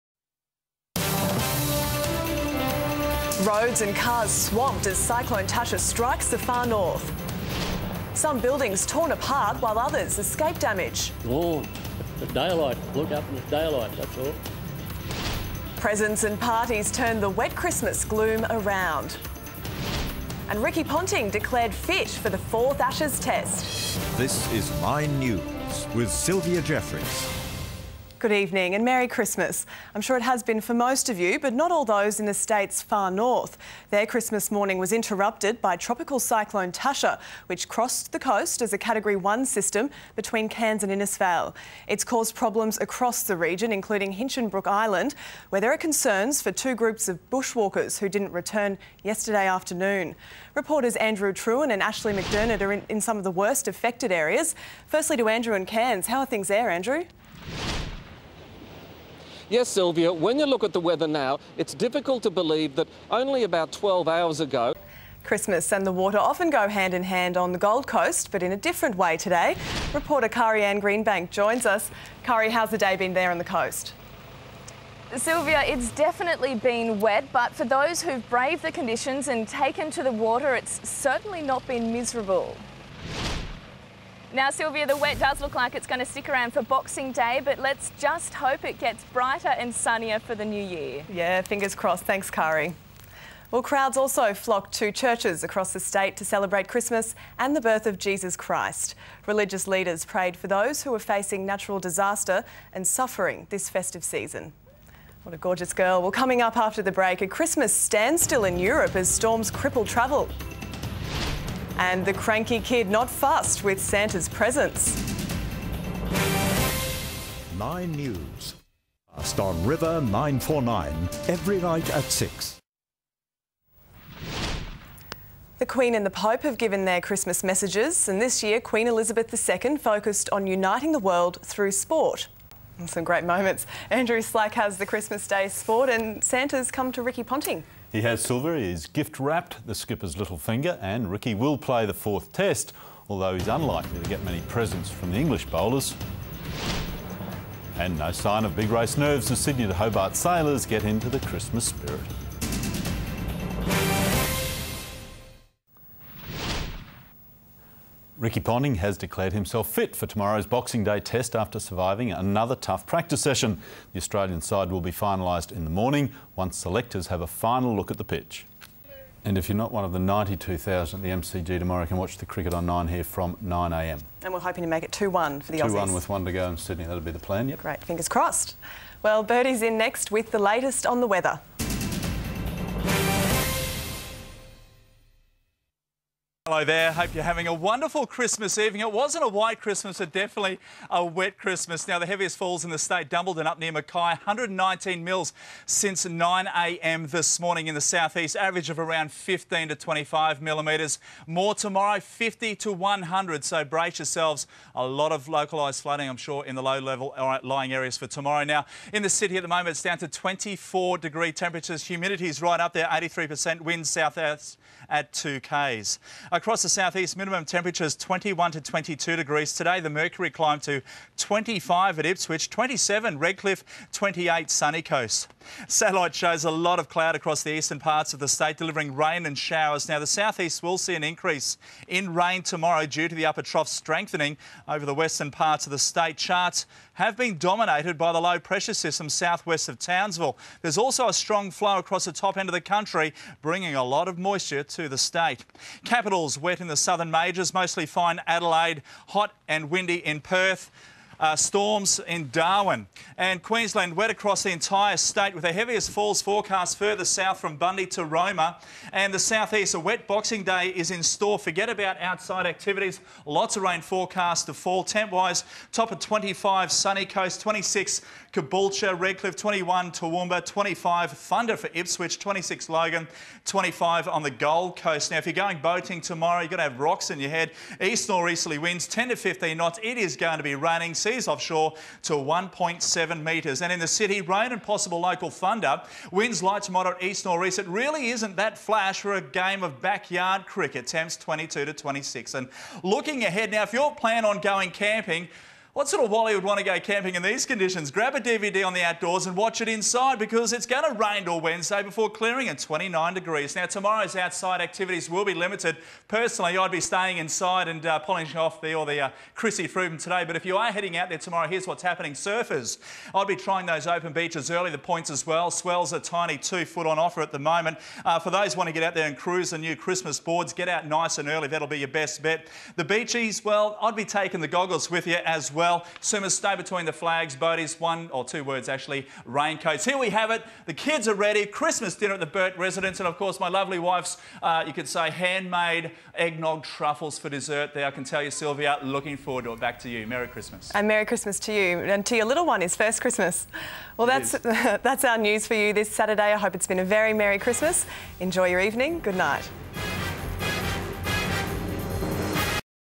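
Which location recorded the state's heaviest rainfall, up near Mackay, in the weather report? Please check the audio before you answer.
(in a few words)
Dumbleton.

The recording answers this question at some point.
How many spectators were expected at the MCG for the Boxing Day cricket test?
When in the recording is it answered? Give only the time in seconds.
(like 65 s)
169 s.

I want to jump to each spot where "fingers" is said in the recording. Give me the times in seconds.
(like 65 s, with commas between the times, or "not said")
91 s, 140 s, 177 s.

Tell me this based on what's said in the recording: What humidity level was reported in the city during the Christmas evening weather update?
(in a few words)
83%.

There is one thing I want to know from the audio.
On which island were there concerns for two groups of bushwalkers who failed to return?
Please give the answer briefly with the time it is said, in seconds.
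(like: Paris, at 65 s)
Hinchinbrook Island, at 44 s.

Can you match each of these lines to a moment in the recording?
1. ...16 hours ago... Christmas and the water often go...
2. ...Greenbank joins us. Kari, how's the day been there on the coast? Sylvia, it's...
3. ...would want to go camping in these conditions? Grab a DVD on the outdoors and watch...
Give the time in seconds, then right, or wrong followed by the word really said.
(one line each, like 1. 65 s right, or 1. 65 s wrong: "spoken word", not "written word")
1. 63 s wrong: "12", not "16"
2. 70 s right
3. 296 s right.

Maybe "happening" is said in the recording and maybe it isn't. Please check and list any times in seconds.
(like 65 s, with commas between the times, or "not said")
311 s.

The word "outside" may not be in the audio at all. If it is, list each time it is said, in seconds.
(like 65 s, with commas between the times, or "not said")
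262 s, 304 s.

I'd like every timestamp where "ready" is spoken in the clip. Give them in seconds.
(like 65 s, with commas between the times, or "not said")
331 s.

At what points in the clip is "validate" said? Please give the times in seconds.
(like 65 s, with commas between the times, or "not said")
not said.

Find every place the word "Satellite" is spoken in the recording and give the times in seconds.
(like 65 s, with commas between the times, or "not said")
225 s.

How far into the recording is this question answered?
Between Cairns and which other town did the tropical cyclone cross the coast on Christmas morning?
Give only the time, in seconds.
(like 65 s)
40 s.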